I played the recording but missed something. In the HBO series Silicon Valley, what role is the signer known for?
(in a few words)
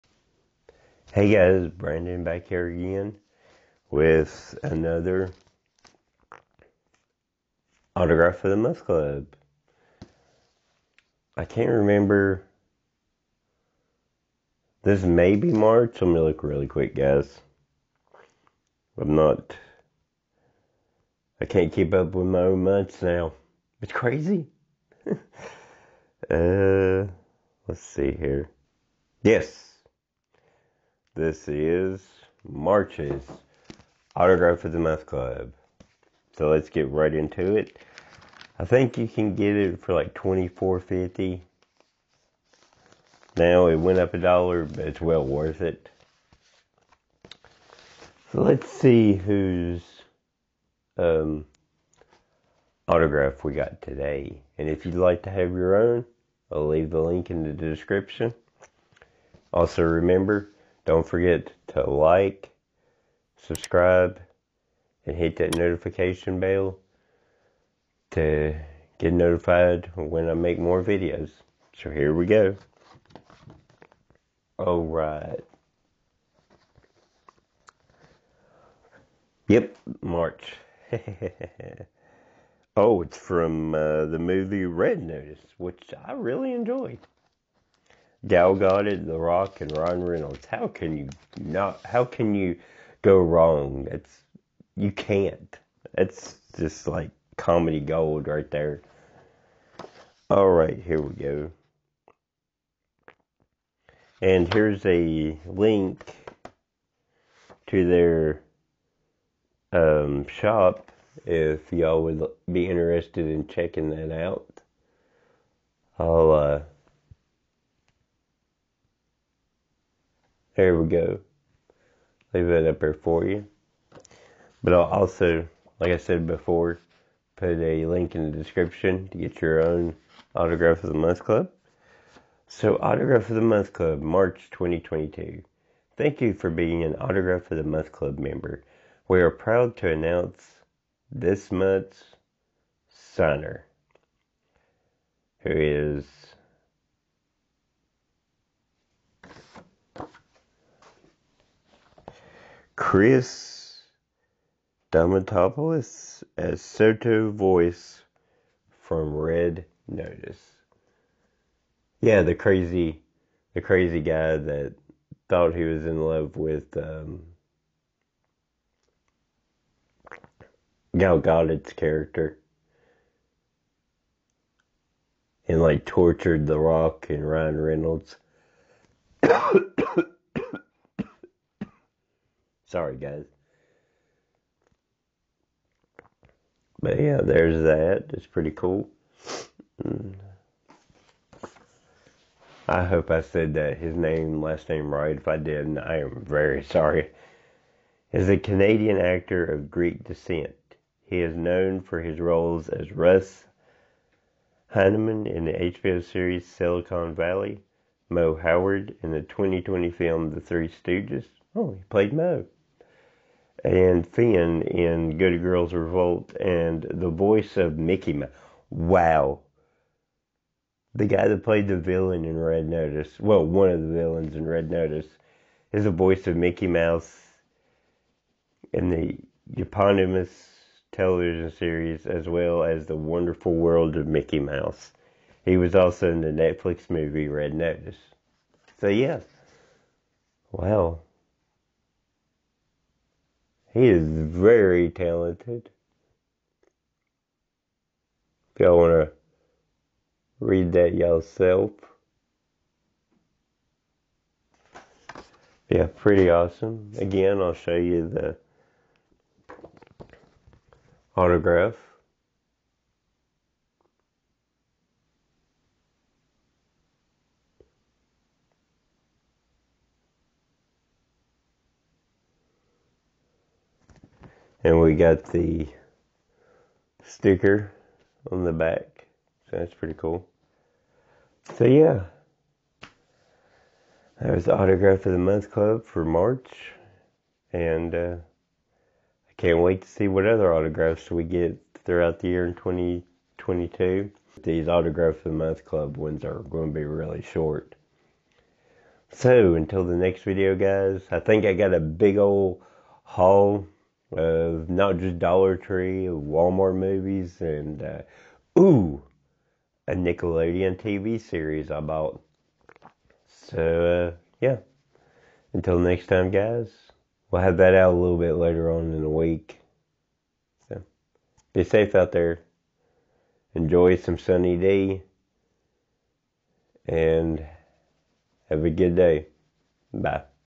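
Russ Hanneman.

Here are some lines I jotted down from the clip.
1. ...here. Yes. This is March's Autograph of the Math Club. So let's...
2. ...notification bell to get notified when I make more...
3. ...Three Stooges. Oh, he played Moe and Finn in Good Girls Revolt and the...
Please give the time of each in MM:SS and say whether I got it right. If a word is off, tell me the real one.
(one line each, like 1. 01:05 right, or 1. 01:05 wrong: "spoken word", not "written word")
1. 00:28 right
2. 01:05 right
3. 03:30 right.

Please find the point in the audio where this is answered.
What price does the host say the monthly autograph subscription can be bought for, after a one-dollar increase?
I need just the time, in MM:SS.
00:40.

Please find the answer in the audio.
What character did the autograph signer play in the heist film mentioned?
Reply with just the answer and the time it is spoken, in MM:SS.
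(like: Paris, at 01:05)
Sotto Voce, at 02:36.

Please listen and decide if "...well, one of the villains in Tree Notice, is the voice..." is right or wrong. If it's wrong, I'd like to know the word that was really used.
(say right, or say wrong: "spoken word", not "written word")
wrong: "Red", not "Tree".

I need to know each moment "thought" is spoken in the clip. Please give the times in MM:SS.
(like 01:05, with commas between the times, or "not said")
02:45.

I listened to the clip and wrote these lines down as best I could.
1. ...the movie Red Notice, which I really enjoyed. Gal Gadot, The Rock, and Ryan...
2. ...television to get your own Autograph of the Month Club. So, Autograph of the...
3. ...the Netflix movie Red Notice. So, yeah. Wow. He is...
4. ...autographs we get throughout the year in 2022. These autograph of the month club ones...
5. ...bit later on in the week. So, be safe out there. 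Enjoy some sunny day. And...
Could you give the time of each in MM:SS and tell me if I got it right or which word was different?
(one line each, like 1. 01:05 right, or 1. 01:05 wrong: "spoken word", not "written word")
1. 01:24 right
2. 02:08 wrong: "description", not "television"
3. 03:56 right
4. 04:50 right
5. 05:18 right.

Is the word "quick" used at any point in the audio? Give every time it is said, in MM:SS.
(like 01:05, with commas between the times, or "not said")
00:16.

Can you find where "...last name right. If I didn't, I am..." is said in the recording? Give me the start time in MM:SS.
03:14.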